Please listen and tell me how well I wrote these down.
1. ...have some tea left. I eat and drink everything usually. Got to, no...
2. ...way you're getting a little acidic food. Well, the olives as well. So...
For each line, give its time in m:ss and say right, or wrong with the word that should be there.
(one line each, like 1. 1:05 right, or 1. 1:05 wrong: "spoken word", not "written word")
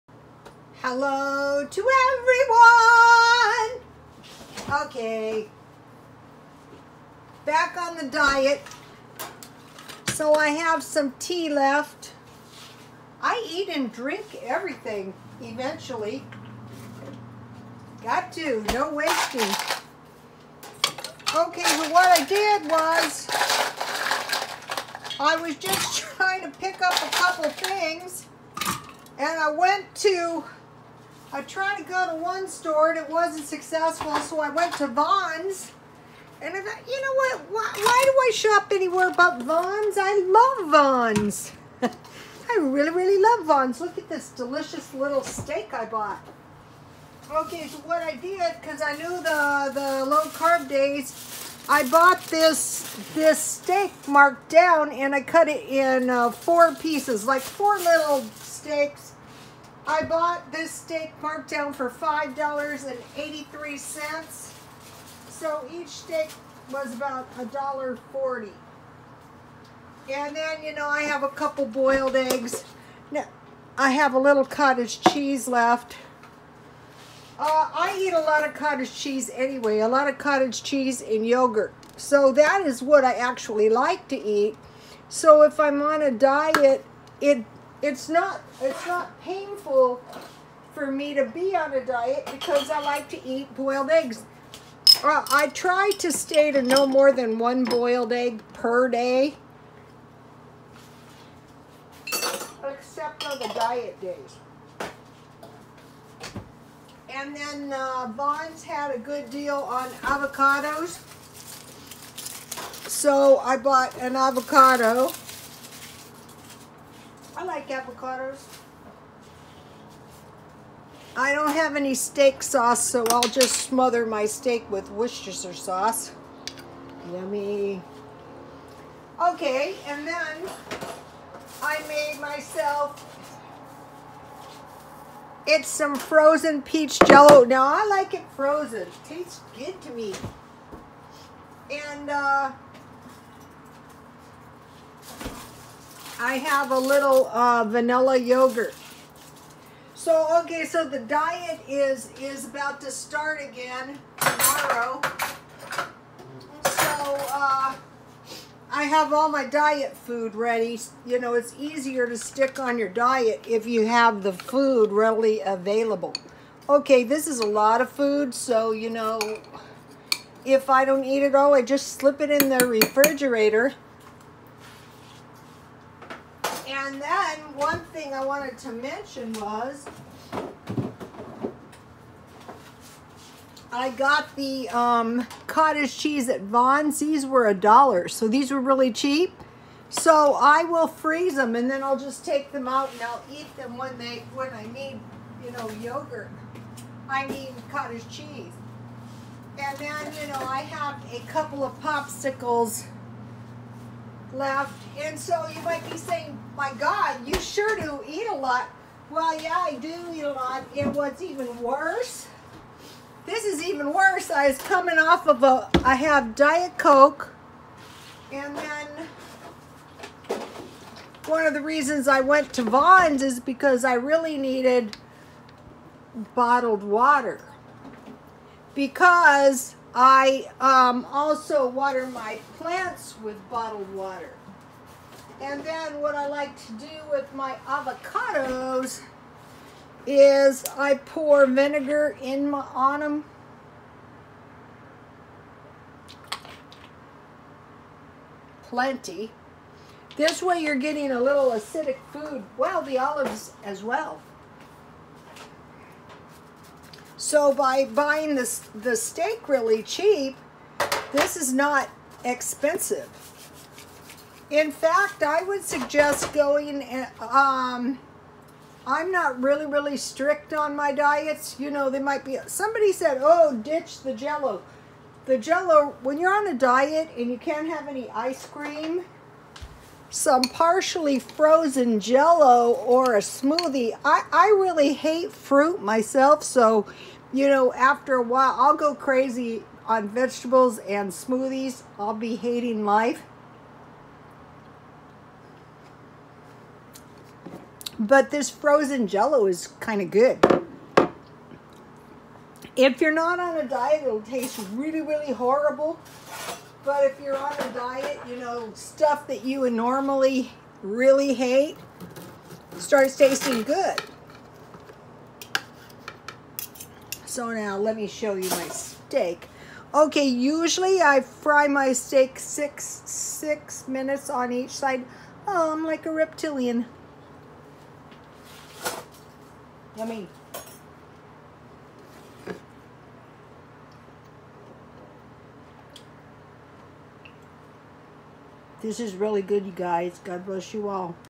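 1. 0:10 wrong: "eventually", not "usually"
2. 4:10 right.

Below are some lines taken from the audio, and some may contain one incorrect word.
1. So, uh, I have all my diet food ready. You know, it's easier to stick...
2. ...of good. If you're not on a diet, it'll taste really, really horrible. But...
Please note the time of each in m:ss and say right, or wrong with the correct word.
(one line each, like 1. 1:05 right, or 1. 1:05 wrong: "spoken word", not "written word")
1. 2:36 right
2. 5:00 right.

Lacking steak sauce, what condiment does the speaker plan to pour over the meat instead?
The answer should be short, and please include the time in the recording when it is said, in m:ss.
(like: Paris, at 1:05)
Worcestershire sauce, at 2:04.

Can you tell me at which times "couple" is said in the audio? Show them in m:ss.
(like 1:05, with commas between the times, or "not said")
0:27, 1:11, 3:21.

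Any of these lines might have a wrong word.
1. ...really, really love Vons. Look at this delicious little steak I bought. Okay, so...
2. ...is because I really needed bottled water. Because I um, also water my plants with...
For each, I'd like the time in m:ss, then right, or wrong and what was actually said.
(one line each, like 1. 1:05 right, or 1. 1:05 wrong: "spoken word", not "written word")
1. 0:42 right
2. 3:43 right.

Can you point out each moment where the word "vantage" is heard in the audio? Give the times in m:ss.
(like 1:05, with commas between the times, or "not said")
not said.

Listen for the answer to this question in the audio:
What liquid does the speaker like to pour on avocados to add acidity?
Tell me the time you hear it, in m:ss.
4:01.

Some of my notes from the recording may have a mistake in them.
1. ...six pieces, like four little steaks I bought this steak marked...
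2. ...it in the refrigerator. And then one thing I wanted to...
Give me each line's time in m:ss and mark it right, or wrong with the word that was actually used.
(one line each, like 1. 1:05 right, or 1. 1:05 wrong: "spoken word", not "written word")
1. 0:56 wrong: "four", not "six"
2. 2:52 right.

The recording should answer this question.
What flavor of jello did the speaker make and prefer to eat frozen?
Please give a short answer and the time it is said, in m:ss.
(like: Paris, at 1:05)
Peach, at 2:16.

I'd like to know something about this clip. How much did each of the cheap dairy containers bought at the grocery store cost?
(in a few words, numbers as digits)
A dollar.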